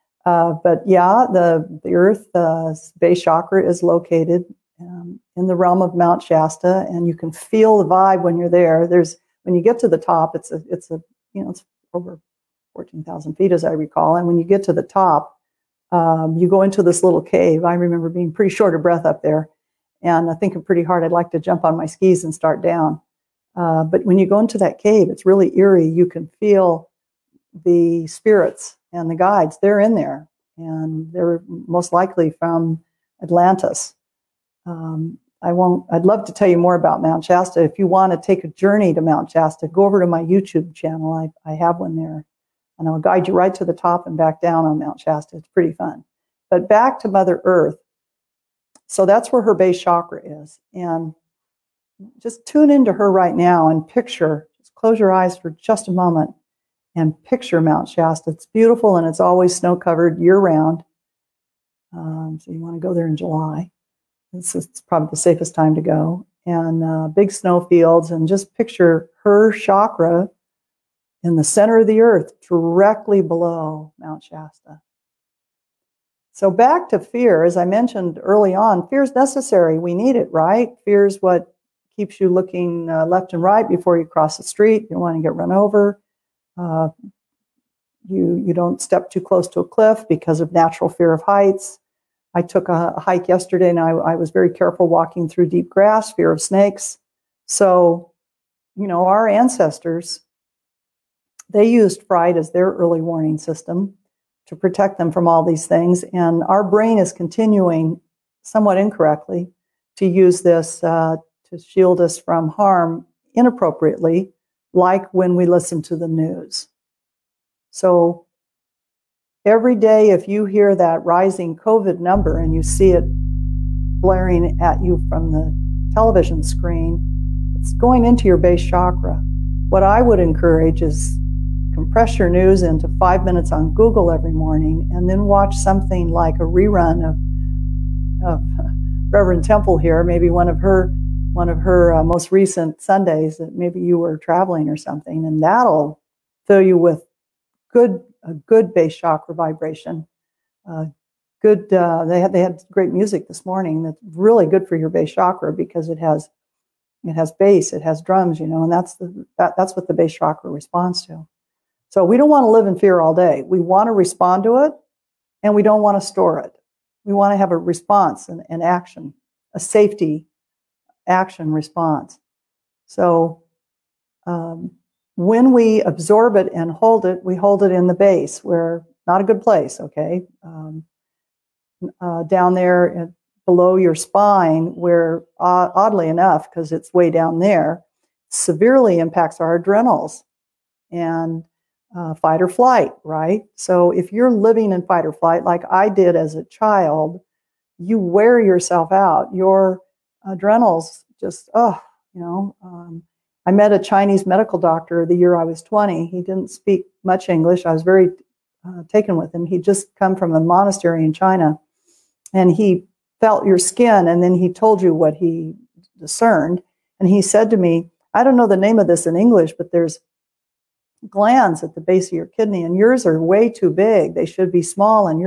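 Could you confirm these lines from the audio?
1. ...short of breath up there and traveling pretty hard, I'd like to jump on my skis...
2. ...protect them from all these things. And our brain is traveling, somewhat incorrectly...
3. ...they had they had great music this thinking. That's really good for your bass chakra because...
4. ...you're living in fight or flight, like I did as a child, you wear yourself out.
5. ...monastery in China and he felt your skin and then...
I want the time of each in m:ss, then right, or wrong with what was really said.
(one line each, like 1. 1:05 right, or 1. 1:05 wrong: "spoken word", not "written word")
1. 0:18 wrong: "thinking", not "traveling"
2. 1:44 wrong: "continuing", not "traveling"
3. 2:32 wrong: "morning", not "thinking"
4. 3:14 right
5. 3:30 right.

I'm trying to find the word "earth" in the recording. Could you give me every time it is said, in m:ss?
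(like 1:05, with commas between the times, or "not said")
0:01, 0:47, 1:11.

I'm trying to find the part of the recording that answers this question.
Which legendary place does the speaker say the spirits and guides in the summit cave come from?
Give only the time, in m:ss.
0:33.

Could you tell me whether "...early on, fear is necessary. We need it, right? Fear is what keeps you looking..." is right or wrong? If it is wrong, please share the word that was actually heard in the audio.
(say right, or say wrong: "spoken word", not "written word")
right.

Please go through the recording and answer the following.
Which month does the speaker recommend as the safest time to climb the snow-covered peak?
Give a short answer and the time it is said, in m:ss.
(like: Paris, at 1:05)
July, at 1:03.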